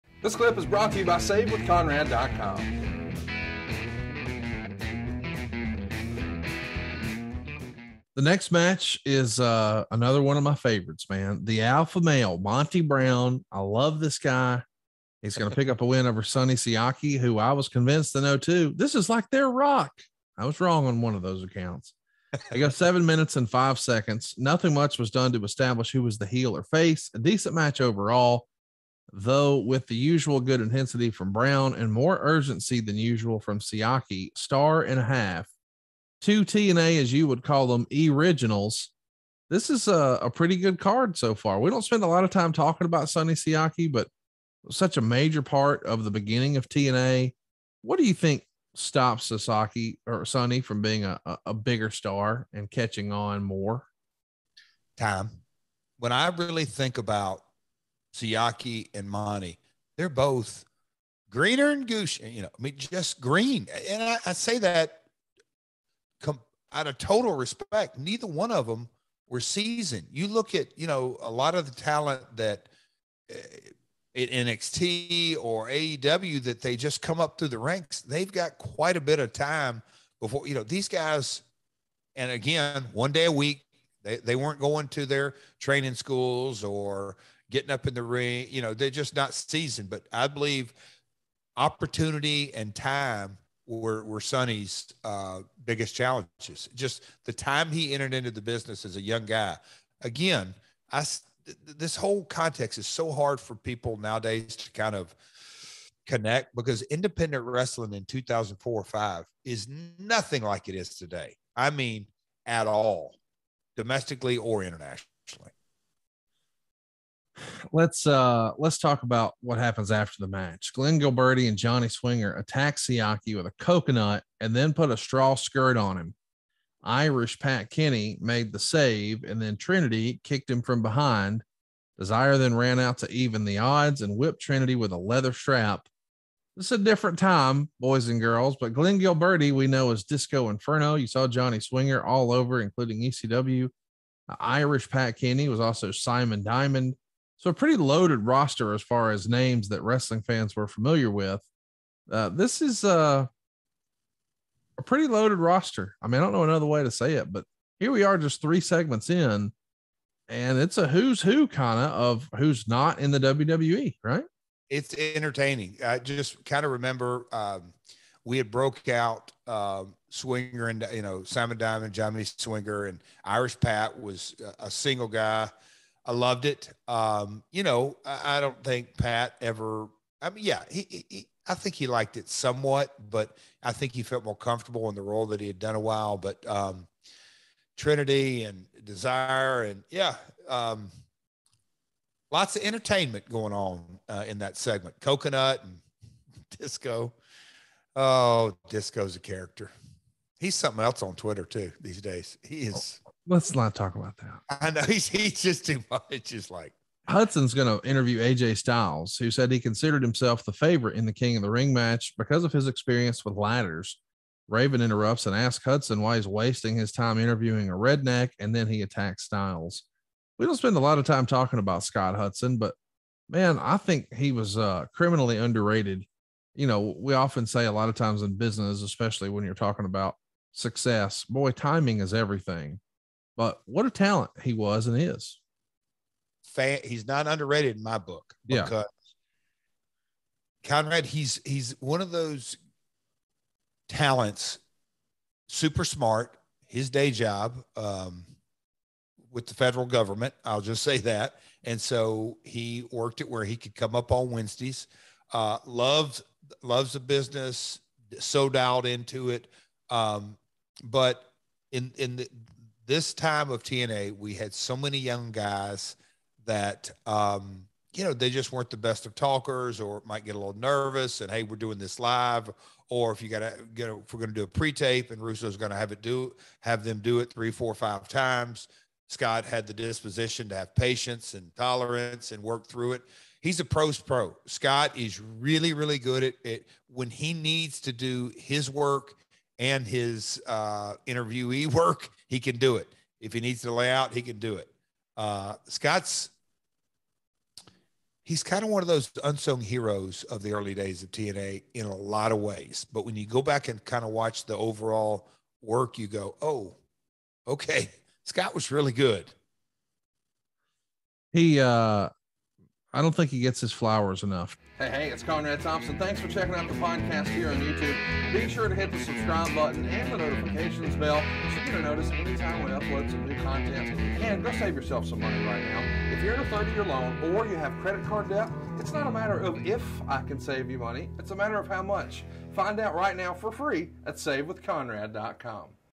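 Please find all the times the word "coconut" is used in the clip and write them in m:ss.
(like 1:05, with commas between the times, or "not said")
2:03, 3:15.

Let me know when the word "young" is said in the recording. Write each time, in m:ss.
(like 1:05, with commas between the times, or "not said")
1:39, 4:24.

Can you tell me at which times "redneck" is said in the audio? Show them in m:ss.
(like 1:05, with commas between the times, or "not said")
3:37.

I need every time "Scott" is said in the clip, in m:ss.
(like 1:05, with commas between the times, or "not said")
3:41, 4:39, 4:44, 4:55, 5:08.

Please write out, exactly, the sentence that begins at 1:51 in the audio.
I mean, at all, domestically or internationally let's uh let's talk about what happens after the match.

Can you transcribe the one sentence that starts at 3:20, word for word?
He's something else on Twitter too these days.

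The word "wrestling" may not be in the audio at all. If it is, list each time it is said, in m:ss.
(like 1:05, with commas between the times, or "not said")
1:47, 2:29.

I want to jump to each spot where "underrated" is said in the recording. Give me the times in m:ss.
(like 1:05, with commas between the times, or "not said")
3:45, 3:57.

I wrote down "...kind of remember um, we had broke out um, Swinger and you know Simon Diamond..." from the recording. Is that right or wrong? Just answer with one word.
right.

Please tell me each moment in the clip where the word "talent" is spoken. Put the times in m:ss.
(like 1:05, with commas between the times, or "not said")
1:11, 3:53, 4:03.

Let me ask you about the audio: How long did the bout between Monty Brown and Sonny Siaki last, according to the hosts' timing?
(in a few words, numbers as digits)
7 minutes 5 seconds.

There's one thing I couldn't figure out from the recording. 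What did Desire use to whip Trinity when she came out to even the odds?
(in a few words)
Leather strap.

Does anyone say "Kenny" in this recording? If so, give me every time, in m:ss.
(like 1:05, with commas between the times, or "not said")
2:07, 2:25.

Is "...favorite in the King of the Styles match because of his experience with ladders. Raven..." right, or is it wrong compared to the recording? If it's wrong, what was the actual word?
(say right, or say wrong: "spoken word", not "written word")
wrong: "Ring", not "Styles".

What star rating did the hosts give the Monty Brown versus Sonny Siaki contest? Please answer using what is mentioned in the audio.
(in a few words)
1.5 stars.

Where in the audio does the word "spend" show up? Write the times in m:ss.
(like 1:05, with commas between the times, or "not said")
0:41, 3:40.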